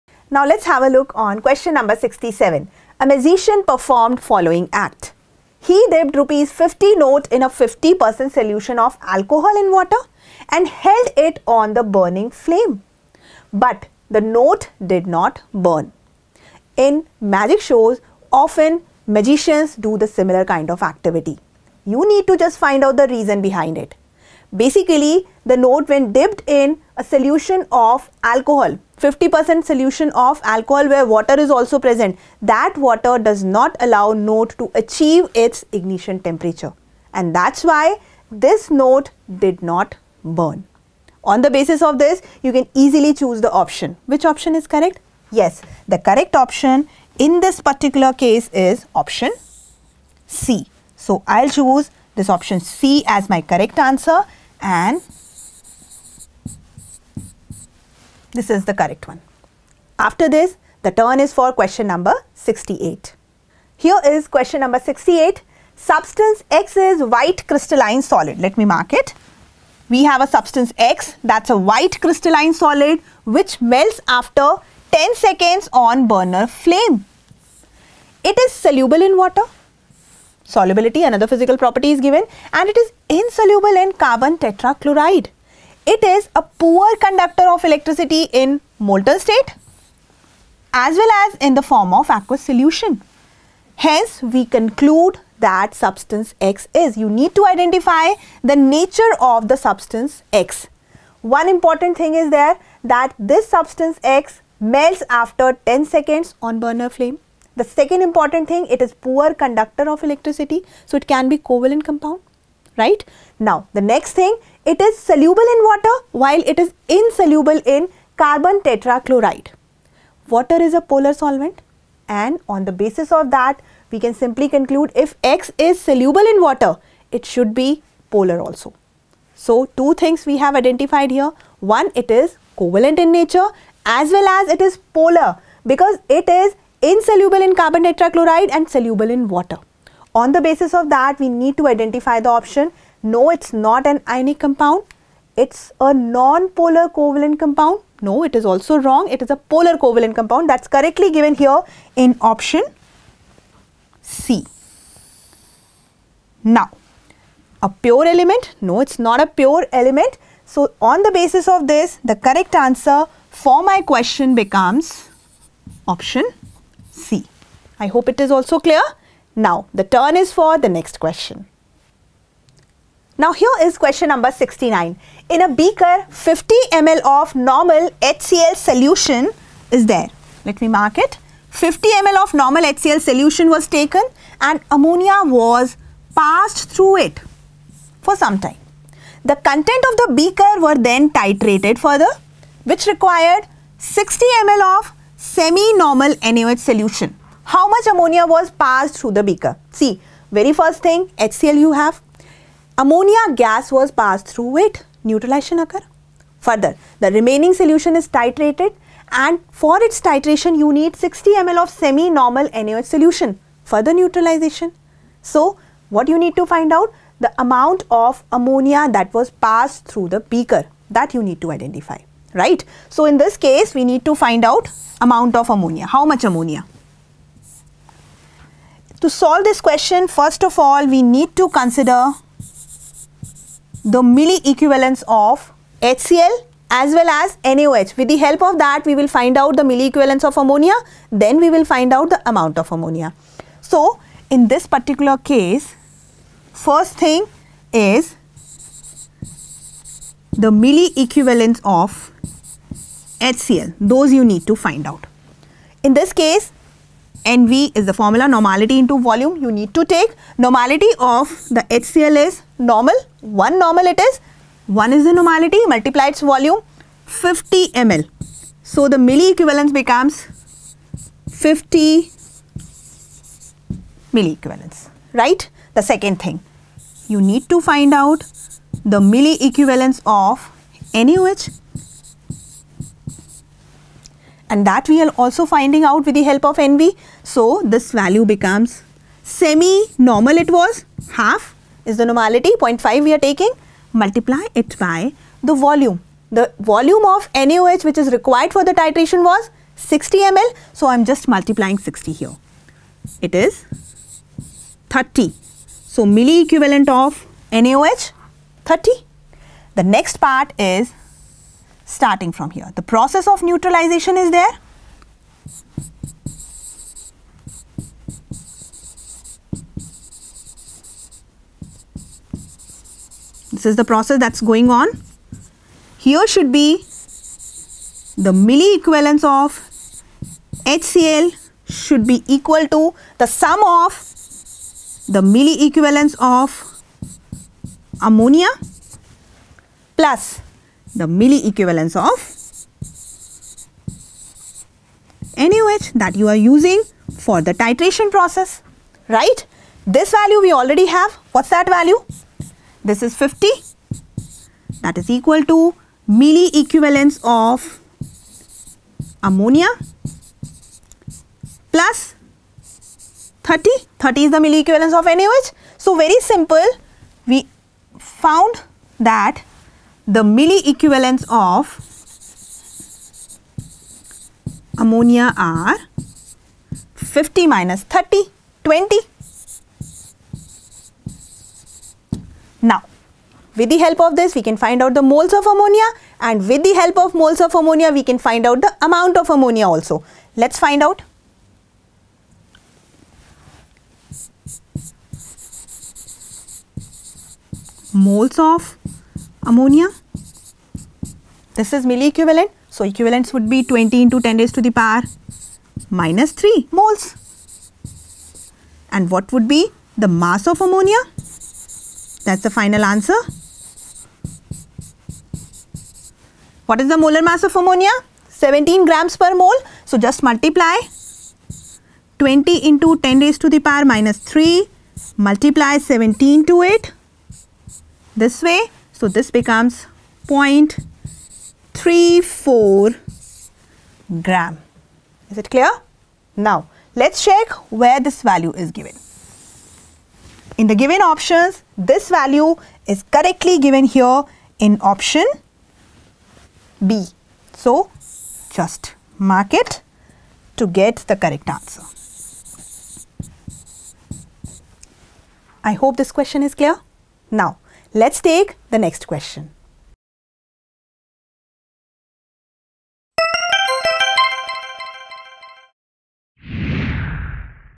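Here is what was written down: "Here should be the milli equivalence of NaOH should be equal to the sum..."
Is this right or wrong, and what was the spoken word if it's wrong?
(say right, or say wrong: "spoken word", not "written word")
wrong: "HCl", not "NaOH".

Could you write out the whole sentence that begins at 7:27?
So, just mark it to get the correct answer.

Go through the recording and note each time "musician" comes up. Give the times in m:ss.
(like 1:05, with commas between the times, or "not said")
0:03.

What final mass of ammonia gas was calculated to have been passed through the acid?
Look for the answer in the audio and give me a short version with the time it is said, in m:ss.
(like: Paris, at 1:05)
0.34 gram, at 7:10.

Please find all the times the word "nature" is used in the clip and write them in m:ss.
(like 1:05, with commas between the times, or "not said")
1:38, 2:13.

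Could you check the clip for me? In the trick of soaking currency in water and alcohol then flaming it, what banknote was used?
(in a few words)
Rupees 50.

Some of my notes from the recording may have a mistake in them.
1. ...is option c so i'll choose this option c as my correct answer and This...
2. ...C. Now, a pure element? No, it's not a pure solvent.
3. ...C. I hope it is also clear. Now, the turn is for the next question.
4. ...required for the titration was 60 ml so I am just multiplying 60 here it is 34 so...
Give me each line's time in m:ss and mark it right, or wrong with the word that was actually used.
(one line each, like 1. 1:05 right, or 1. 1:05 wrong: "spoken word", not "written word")
1. 0:48 right
2. 2:34 wrong: "element", not "solvent"
3. 2:46 right
4. 4:58 wrong: "30", not "34".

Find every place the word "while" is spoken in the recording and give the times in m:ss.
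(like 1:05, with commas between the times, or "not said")
1:56.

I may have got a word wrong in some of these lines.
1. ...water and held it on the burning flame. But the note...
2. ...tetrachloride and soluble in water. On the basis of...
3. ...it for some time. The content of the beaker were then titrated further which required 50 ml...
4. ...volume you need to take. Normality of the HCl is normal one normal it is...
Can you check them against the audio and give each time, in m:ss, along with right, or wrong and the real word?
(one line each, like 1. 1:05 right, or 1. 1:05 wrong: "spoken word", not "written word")
1. 0:09 right
2. 2:17 right
3. 3:07 wrong: "60", not "50"
4. 4:18 right.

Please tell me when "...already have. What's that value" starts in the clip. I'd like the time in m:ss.
5:50.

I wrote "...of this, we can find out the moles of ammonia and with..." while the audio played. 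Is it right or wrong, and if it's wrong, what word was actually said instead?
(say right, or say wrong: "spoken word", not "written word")
right.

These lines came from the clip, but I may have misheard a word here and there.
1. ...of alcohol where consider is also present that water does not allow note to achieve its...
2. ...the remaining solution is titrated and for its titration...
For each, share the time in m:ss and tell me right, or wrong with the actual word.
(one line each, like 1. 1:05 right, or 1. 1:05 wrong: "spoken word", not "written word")
1. 0:30 wrong: "water", not "consider"
2. 3:26 right.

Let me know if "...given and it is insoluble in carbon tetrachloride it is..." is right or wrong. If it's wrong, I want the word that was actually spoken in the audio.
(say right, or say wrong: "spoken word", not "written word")
right.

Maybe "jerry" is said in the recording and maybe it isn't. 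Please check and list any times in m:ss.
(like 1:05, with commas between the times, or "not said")
not said.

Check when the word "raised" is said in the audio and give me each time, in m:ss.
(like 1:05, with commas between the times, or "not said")
6:44, 7:03.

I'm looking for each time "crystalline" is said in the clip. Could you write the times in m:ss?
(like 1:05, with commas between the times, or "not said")
1:07, 1:11.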